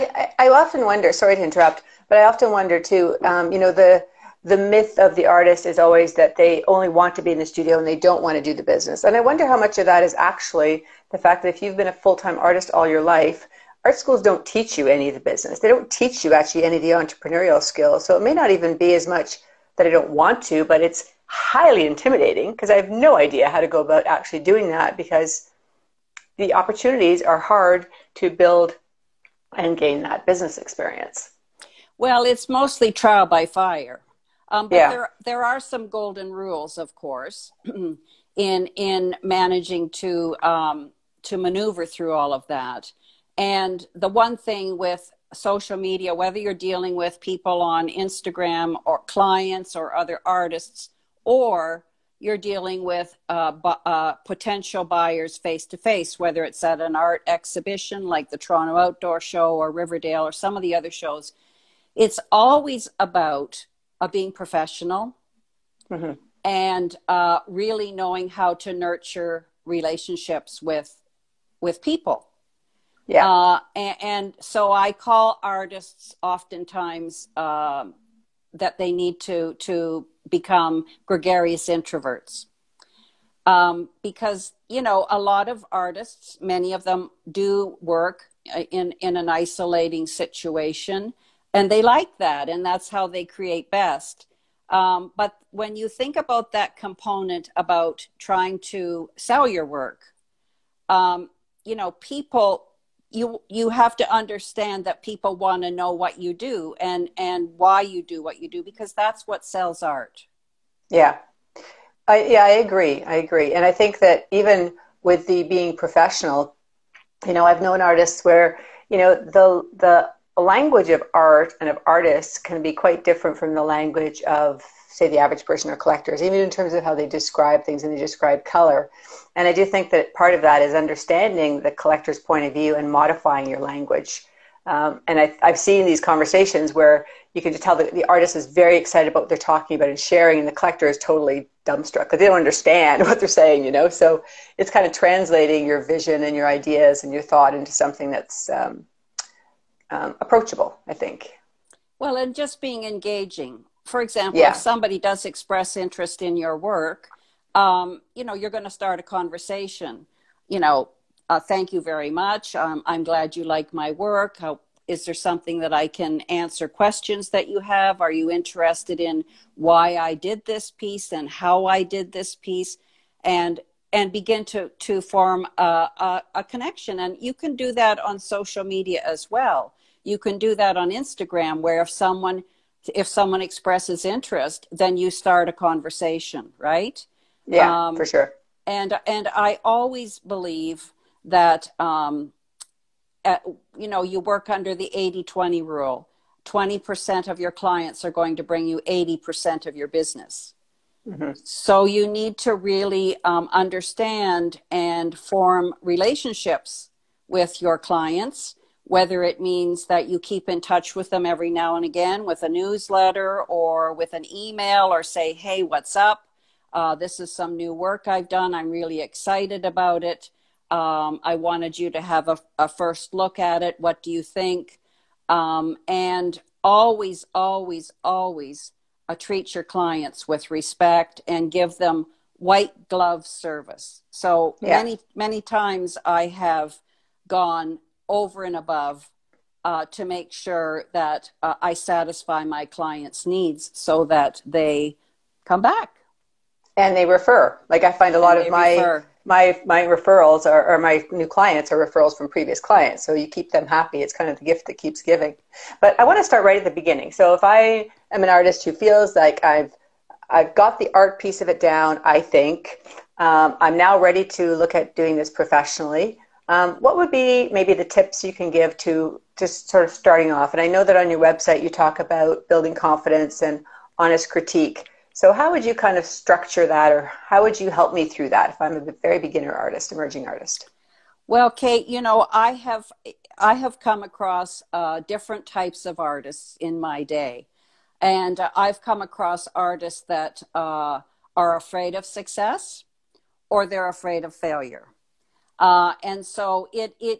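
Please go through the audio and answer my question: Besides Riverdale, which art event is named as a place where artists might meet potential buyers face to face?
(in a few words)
Toronto Outdoor Show.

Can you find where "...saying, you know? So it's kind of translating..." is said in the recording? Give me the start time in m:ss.
2:23.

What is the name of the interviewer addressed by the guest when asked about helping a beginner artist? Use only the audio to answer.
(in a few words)
Kate.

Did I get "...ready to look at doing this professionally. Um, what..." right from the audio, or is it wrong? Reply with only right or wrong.
right.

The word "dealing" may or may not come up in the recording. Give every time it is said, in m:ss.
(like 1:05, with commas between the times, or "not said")
0:46, 0:52.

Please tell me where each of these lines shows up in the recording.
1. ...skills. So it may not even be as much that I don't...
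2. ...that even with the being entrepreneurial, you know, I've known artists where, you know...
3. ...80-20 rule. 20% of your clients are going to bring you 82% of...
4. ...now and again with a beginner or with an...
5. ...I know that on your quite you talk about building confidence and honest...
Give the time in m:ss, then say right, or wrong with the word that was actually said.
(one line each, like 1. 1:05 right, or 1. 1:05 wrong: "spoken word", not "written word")
1. 0:17 right
2. 1:53 wrong: "professional", not "entrepreneurial"
3. 3:14 wrong: "80", not "82"
4. 3:31 wrong: "newsletter", not "beginner"
5. 4:30 wrong: "website", not "quite".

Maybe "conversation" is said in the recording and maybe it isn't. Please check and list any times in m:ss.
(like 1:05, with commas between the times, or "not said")
2:15, 2:39, 3:05.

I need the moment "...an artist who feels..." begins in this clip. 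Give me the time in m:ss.
4:18.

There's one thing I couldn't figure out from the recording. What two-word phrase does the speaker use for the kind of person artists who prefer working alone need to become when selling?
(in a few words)
gregarious introverts.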